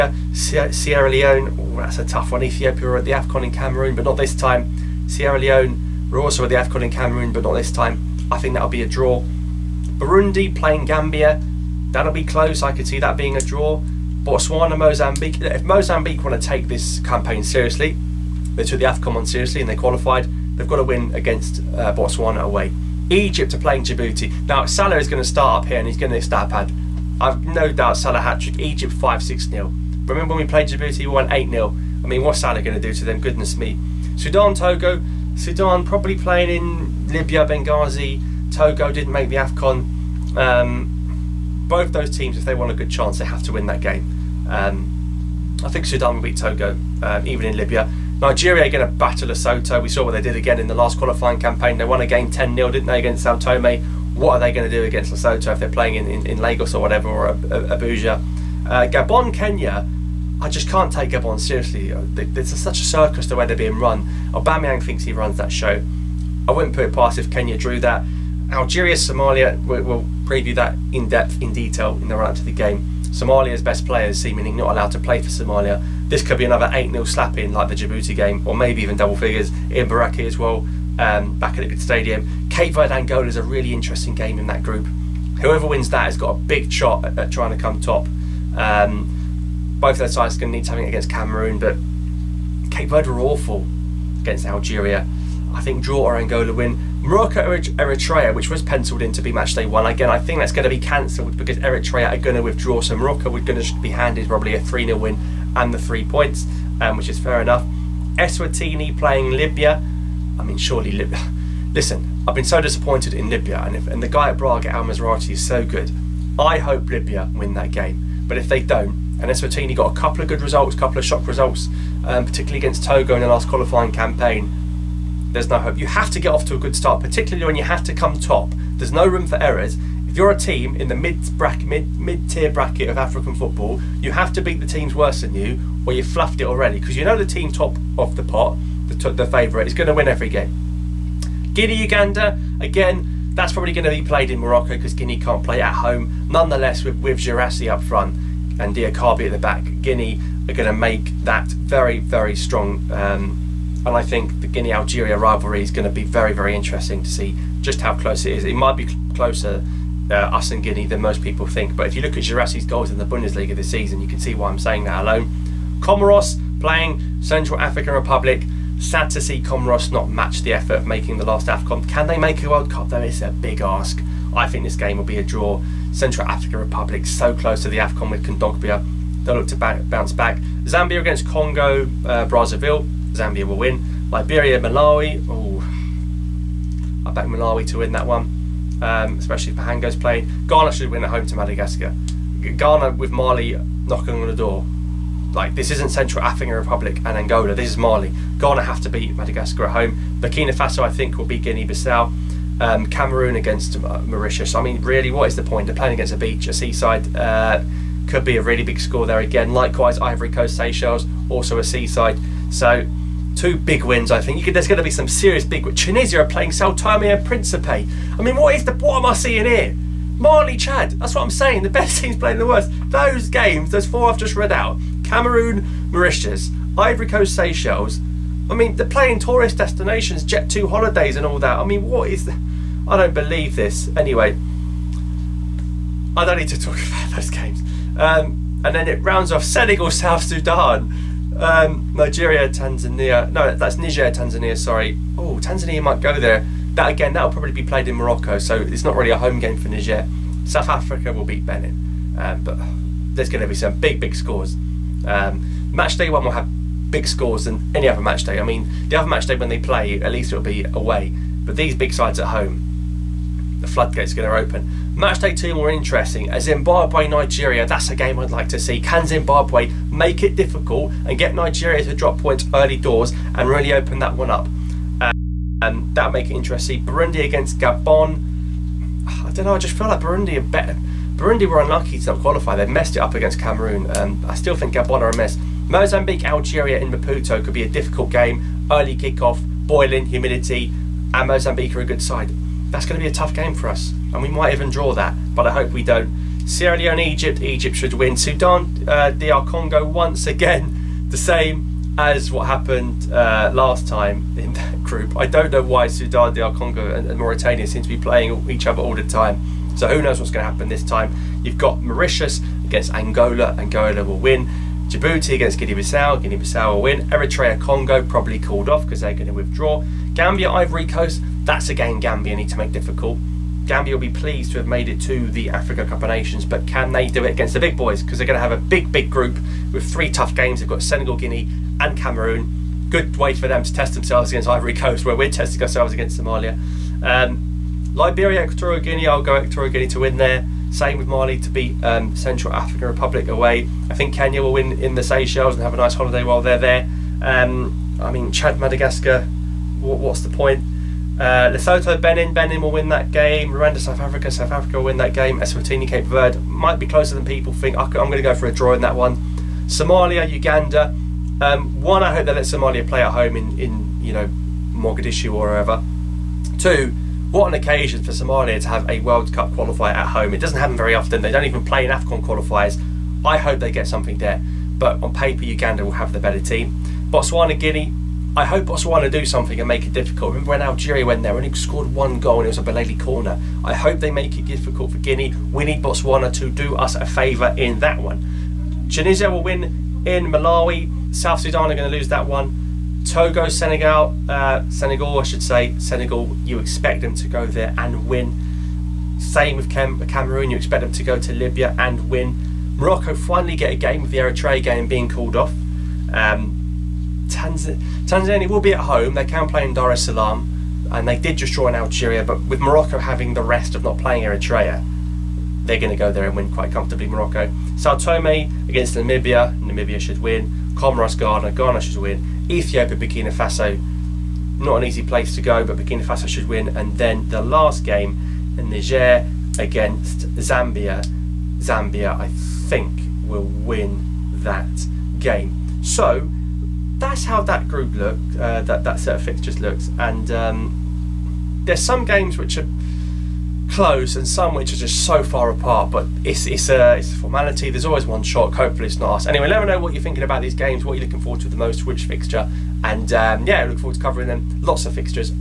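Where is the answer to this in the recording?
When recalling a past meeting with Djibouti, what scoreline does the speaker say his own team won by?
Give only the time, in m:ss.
0:31.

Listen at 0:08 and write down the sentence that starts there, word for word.
I think that'll be a draw.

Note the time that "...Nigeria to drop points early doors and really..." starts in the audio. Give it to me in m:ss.
4:31.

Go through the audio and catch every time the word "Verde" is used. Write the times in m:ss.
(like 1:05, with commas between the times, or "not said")
1:22, 1:32, 5:56.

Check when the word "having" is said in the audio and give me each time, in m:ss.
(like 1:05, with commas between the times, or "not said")
6:52.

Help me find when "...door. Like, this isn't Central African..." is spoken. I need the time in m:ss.
3:14.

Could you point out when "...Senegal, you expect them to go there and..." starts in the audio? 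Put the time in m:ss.
6:35.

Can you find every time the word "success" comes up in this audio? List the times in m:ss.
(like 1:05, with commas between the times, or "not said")
not said.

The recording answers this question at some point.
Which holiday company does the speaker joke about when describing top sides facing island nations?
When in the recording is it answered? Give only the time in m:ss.
3:50.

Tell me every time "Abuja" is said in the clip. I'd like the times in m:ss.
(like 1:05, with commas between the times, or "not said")
0:57.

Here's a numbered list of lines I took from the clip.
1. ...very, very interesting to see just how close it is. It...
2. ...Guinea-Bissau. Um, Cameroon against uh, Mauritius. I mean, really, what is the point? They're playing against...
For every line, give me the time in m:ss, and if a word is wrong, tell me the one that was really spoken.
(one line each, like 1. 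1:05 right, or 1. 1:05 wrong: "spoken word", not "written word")
1. 2:36 right
2. 3:21 right.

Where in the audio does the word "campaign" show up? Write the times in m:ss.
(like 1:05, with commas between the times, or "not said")
0:17, 0:51, 2:03.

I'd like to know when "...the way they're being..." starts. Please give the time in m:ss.
1:03.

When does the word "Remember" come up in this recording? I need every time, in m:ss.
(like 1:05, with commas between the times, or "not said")
0:30, 6:20.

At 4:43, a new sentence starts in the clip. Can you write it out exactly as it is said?
Um, I still think Gabon are a mess.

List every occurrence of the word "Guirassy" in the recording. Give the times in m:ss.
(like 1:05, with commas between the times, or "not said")
2:27, 2:42.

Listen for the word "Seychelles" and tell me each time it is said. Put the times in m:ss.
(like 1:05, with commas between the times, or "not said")
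3:30, 3:47, 5:45.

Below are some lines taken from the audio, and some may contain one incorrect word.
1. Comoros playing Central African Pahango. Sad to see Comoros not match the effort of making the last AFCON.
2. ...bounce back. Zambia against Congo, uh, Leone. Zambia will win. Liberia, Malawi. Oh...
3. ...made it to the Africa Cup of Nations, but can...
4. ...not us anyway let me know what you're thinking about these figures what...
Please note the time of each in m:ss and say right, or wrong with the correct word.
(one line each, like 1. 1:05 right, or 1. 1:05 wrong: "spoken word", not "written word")
1. 2:45 wrong: "Republic", not "Pahango"
2. 2:59 wrong: "Brazzaville", not "Leone"
3. 5:24 right
4. 7:29 wrong: "games", not "figures".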